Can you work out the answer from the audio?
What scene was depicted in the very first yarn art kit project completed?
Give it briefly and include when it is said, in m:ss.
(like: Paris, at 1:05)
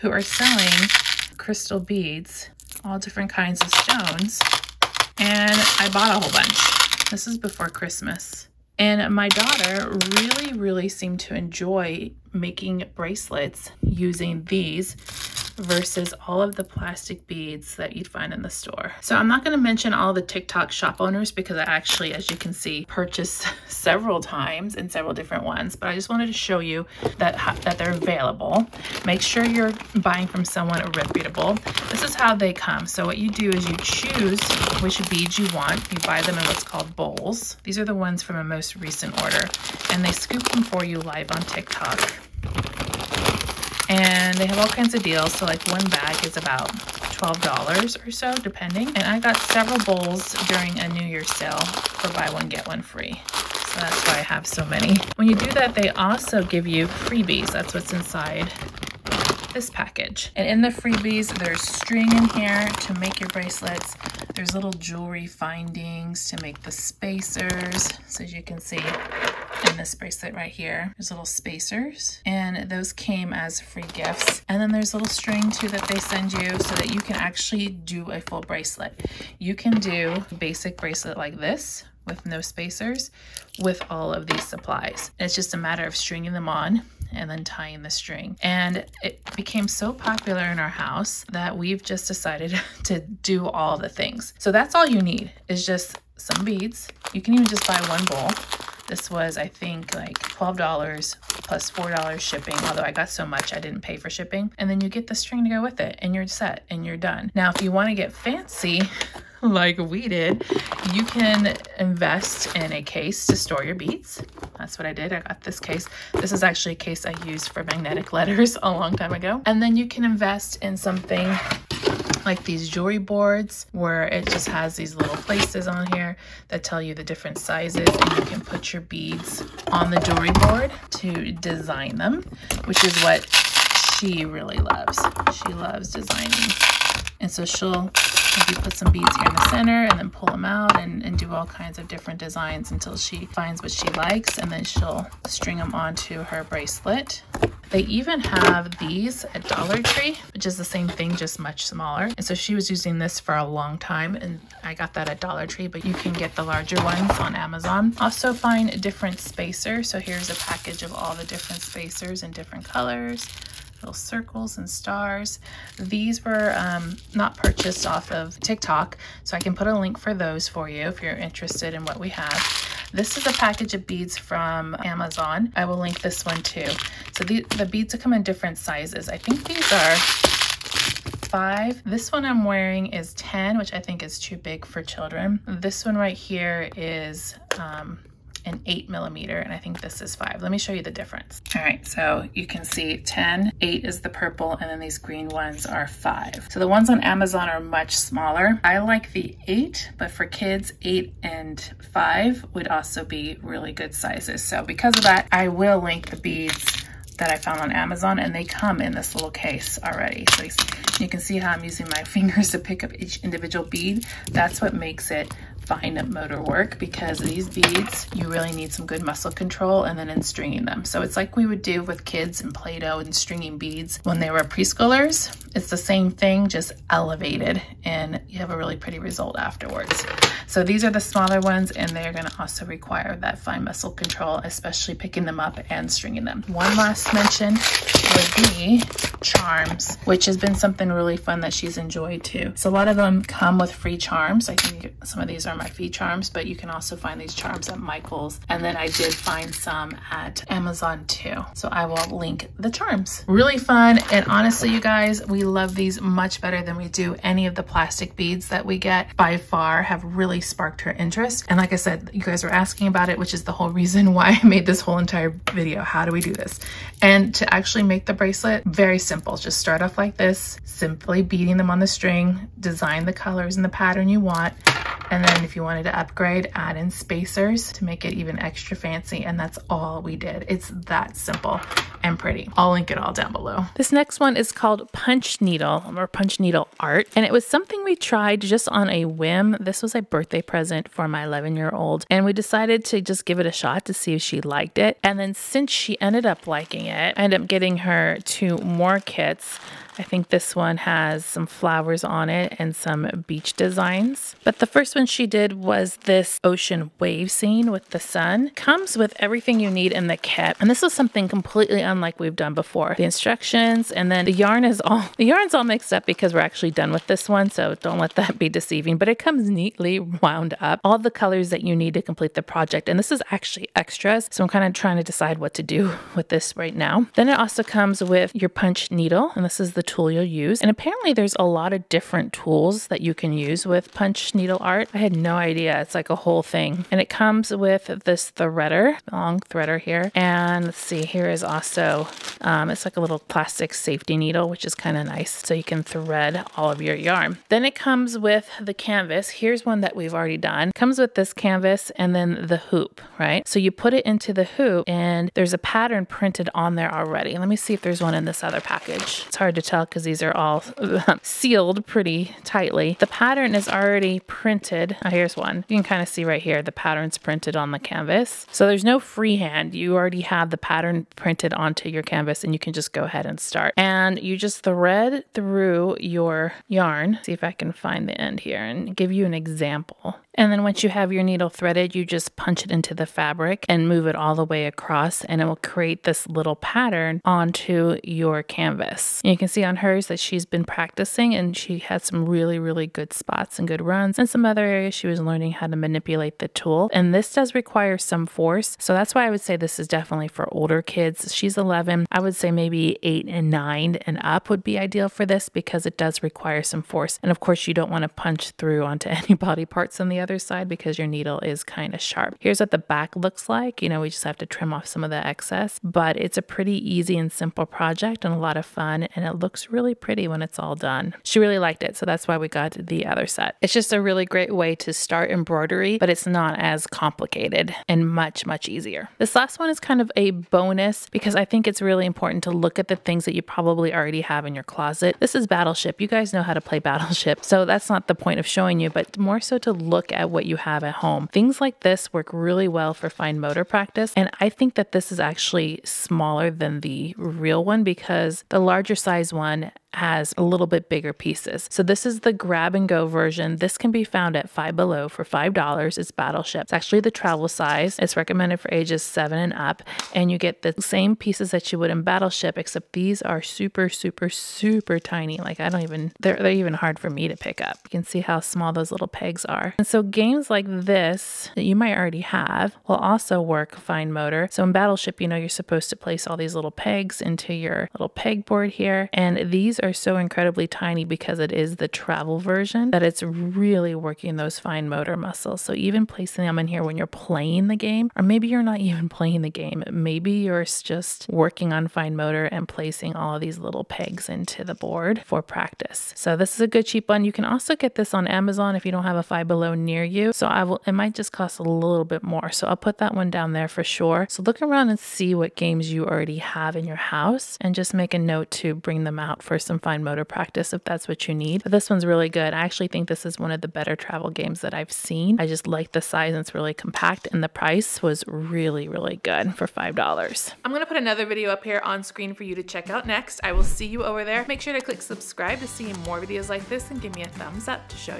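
ocean wave scene with the sun, at 5:06.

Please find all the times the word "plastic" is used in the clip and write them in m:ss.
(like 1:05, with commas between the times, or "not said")
0:16, 4:17, 5:43.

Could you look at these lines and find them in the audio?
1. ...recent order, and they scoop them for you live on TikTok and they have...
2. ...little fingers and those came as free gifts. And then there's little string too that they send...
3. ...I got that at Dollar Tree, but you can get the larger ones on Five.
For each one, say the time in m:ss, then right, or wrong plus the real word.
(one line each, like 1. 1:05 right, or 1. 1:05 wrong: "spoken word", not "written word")
1. 0:38 right
2. 1:11 wrong: "spacers", not "fingers"
3. 2:34 wrong: "Amazon", not "Five".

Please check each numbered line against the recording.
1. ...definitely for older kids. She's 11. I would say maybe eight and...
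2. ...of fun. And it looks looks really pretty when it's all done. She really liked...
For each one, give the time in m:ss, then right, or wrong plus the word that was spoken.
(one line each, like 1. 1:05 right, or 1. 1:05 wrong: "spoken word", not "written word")
1. 6:39 right
2. 6:58 right.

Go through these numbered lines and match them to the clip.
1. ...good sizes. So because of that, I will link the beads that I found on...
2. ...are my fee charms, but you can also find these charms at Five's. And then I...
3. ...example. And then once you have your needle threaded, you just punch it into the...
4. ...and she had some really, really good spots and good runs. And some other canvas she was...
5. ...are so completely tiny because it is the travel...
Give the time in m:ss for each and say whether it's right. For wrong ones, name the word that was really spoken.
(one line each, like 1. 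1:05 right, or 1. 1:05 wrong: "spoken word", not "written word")
1. 3:23 right
2. 4:05 wrong: "Michael", not "Five"
3. 6:19 right
4. 6:31 wrong: "areas", not "canvas"
5. 7:59 wrong: "incredibly", not "completely".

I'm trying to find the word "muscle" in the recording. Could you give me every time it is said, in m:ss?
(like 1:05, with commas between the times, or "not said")
3:39, 3:53, 8:05.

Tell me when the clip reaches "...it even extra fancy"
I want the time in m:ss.
4:38.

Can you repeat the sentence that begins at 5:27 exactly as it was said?
Then it also comes with your punch needle.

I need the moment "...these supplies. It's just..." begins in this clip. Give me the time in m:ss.
1:24.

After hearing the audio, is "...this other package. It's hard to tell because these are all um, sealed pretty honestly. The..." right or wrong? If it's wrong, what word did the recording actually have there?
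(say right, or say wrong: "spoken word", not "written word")
wrong: "tightly", not "honestly".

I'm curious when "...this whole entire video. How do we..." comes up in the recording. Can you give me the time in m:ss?
4:24.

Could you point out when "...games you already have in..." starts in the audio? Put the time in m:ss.
8:25.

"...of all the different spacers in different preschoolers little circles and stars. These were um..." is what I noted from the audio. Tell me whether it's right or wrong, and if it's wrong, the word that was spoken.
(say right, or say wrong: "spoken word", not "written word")
wrong: "colors", not "preschoolers".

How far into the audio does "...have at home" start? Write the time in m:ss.
7:20.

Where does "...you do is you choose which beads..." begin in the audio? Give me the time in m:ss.
0:33.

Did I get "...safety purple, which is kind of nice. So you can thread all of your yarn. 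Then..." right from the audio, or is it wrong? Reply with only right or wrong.
wrong.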